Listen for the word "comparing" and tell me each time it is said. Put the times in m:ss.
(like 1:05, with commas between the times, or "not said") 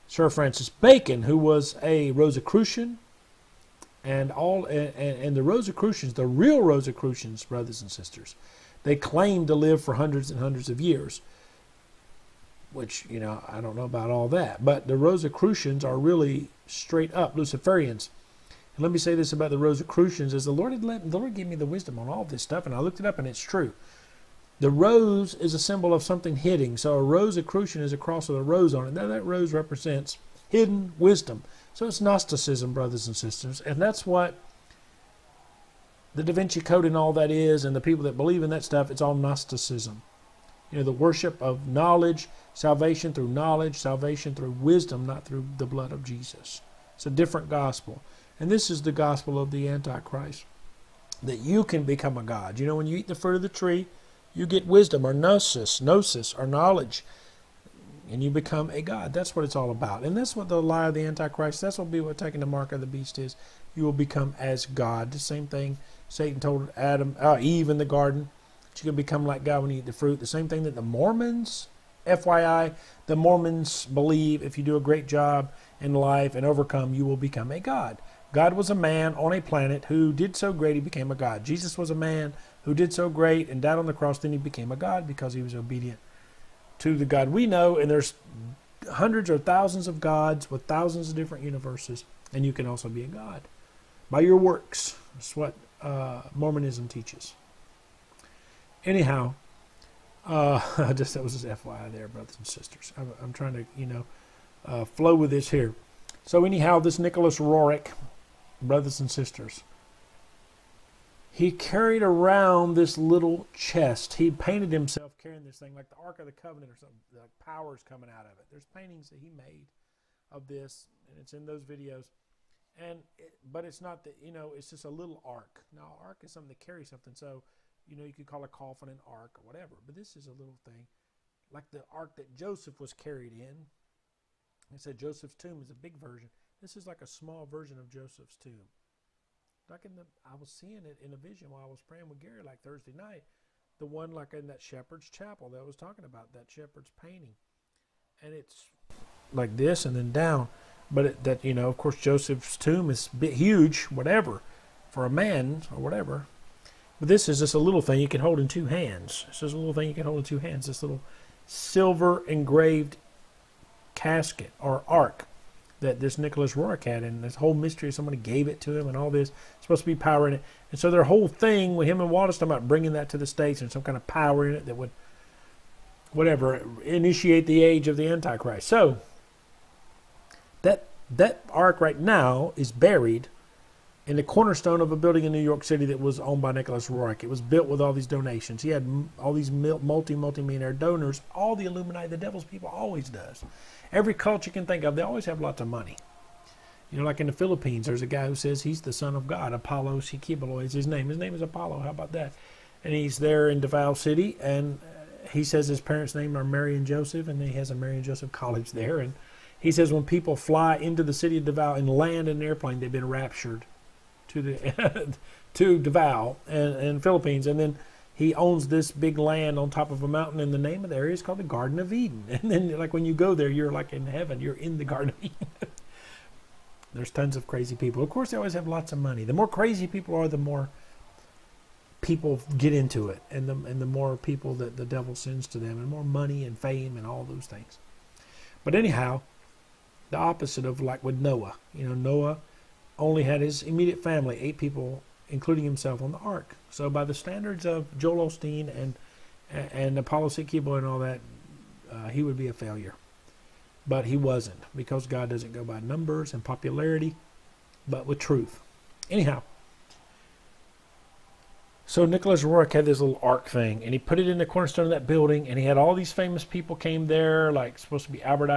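not said.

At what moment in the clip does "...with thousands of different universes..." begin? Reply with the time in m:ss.
1:30.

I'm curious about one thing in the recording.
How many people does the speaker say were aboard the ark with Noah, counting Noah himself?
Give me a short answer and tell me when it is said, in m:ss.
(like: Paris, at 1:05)
8, at 4:04.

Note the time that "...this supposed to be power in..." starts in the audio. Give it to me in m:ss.
2:49.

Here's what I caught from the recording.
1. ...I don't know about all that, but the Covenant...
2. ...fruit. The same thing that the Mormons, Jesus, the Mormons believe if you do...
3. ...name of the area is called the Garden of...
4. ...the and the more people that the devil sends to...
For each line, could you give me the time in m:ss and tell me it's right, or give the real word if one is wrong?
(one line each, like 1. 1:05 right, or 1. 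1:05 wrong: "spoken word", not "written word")
1. 0:13 wrong: "Rosicrucians", not "Covenant"
2. 1:09 wrong: "FYI", not "Jesus"
3. 3:40 right
4. 3:53 right.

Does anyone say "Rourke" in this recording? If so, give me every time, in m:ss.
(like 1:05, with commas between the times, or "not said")
2:46, 4:22.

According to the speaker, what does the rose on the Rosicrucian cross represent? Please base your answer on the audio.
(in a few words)
Hidden wisdom.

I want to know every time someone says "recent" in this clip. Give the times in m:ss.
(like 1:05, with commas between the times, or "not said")
not said.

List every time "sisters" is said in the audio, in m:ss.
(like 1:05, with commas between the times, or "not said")
0:07, 0:33, 1:42, 1:49.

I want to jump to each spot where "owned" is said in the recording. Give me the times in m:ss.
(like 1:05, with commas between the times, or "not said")
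3:06.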